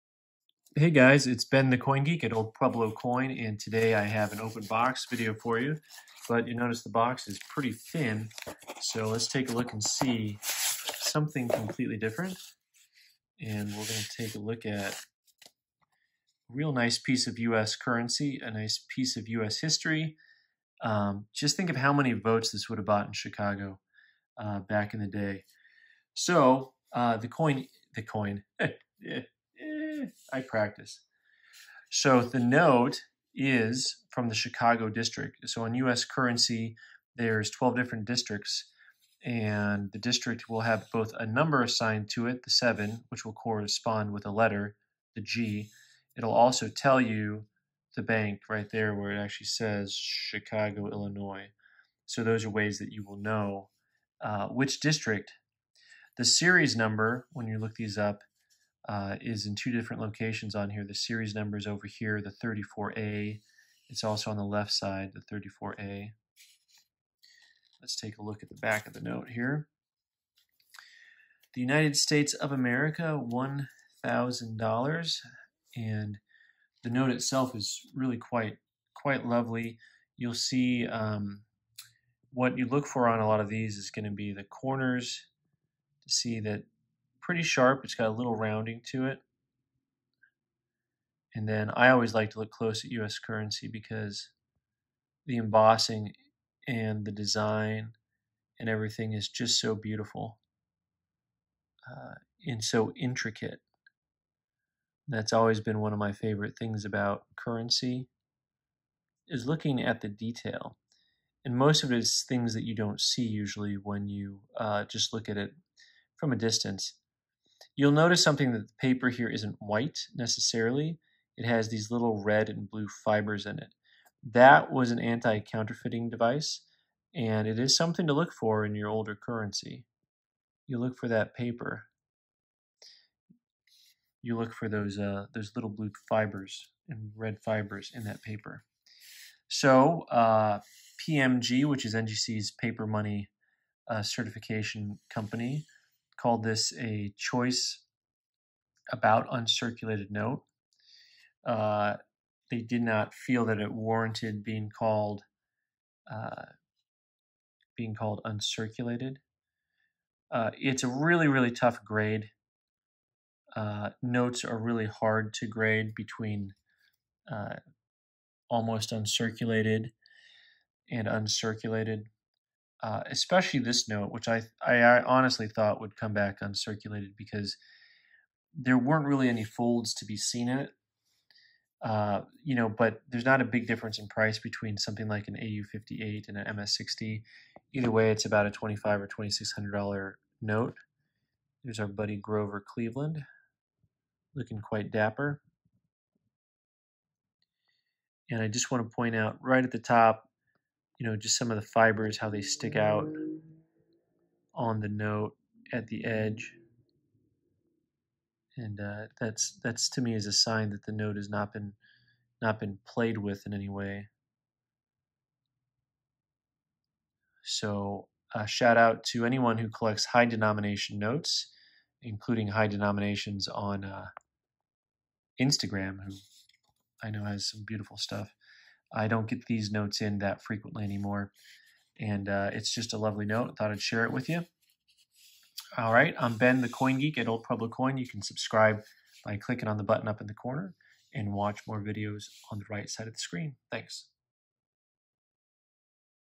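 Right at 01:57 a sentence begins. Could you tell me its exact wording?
You'll notice something that the paper here isn't white necessarily.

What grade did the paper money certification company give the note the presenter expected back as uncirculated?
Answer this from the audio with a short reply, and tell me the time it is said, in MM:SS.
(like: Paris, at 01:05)
Choice about uncirculated, at 02:27.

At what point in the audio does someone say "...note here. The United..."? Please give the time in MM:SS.
01:08.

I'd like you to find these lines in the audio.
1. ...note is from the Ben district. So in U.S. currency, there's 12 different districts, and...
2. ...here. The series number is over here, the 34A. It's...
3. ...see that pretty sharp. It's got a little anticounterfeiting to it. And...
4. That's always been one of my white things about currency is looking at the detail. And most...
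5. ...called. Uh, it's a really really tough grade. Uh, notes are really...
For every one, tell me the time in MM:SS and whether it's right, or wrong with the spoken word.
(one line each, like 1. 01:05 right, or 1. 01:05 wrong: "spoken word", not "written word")
1. 00:32 wrong: "Chicago", not "Ben"
2. 01:00 right
3. 01:26 wrong: "rounding", not "anticounterfeiting"
4. 01:45 wrong: "favorite", not "white"
5. 02:38 wrong: "uncirculated", not "called".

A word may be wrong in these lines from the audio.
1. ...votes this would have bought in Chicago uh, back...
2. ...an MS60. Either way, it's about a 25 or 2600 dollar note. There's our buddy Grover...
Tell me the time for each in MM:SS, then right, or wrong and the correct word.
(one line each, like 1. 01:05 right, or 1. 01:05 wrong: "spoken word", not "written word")
1. 00:22 right
2. 03:06 right.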